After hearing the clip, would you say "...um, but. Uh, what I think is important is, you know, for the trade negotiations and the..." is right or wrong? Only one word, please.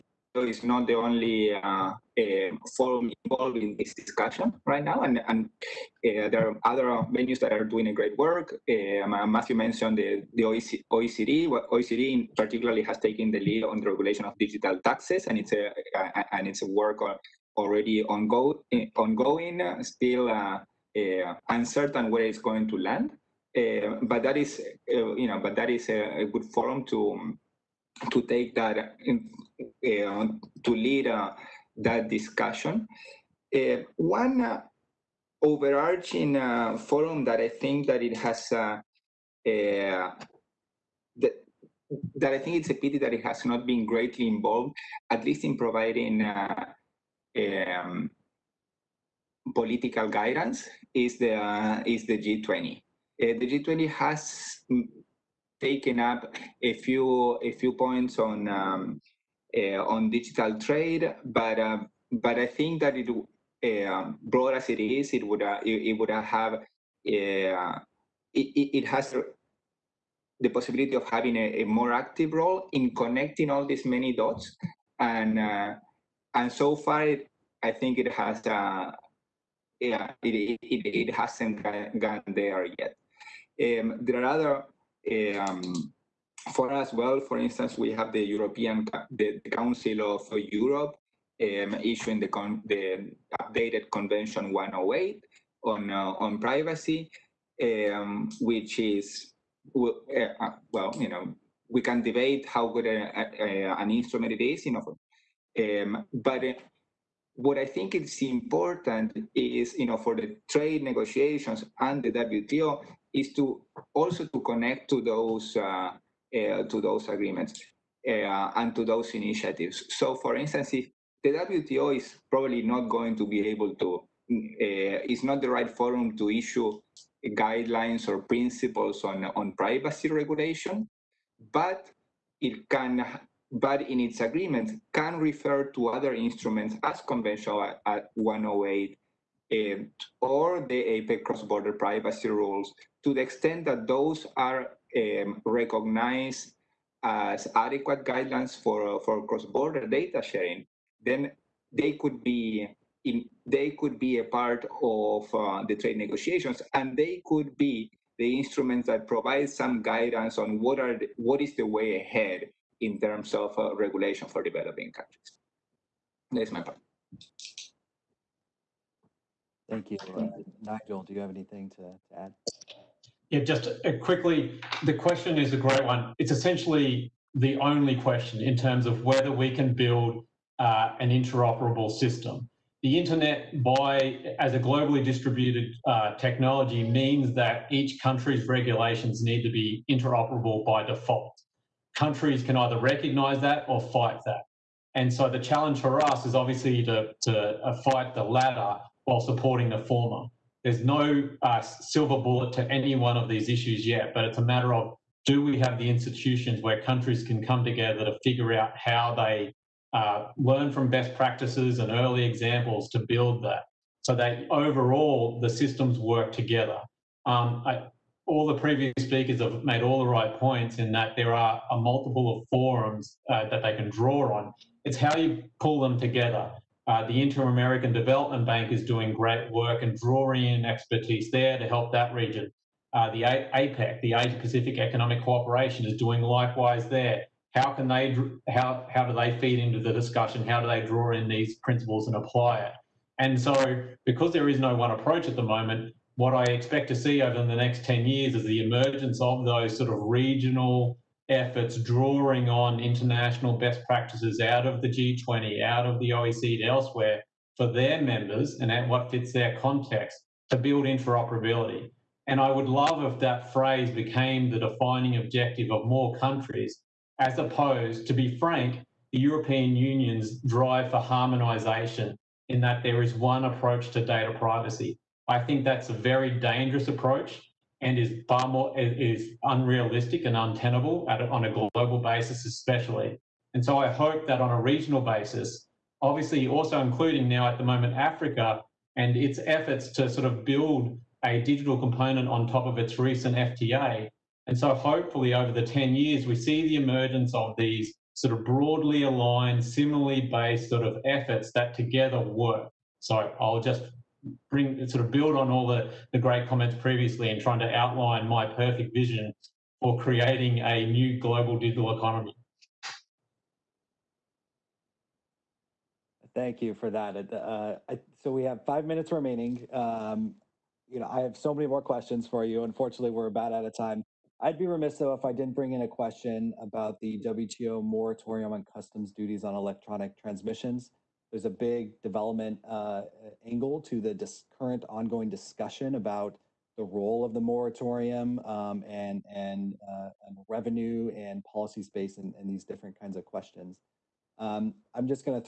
right.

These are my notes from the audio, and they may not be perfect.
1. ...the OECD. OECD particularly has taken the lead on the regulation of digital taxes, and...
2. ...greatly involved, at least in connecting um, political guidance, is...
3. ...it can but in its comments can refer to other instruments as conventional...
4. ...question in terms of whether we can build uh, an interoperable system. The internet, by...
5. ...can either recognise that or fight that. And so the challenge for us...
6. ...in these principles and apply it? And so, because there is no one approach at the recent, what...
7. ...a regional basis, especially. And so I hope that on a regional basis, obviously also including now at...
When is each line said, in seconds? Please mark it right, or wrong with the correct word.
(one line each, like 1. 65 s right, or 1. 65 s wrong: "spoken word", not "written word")
1. 10 s right
2. 43 s wrong: "providing", not "connecting"
3. 132 s wrong: "agreements", not "comments"
4. 177 s right
5. 192 s right
6. 241 s wrong: "moment", not "recent"
7. 281 s wrong: "global", not "regional".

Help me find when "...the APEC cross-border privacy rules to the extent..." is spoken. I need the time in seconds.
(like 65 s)
140 s.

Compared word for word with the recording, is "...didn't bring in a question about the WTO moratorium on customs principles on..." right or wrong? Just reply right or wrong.
wrong.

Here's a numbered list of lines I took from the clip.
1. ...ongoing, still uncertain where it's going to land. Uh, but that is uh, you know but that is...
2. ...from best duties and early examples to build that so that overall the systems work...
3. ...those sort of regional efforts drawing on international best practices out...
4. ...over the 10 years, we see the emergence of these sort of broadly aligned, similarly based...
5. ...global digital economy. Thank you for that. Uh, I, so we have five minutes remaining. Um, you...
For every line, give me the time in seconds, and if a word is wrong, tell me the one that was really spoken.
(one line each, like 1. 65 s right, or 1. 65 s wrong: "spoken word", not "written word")
1. 18 s right
2. 210 s wrong: "practices", not "duties"
3. 249 s right
4. 295 s right
5. 311 s right.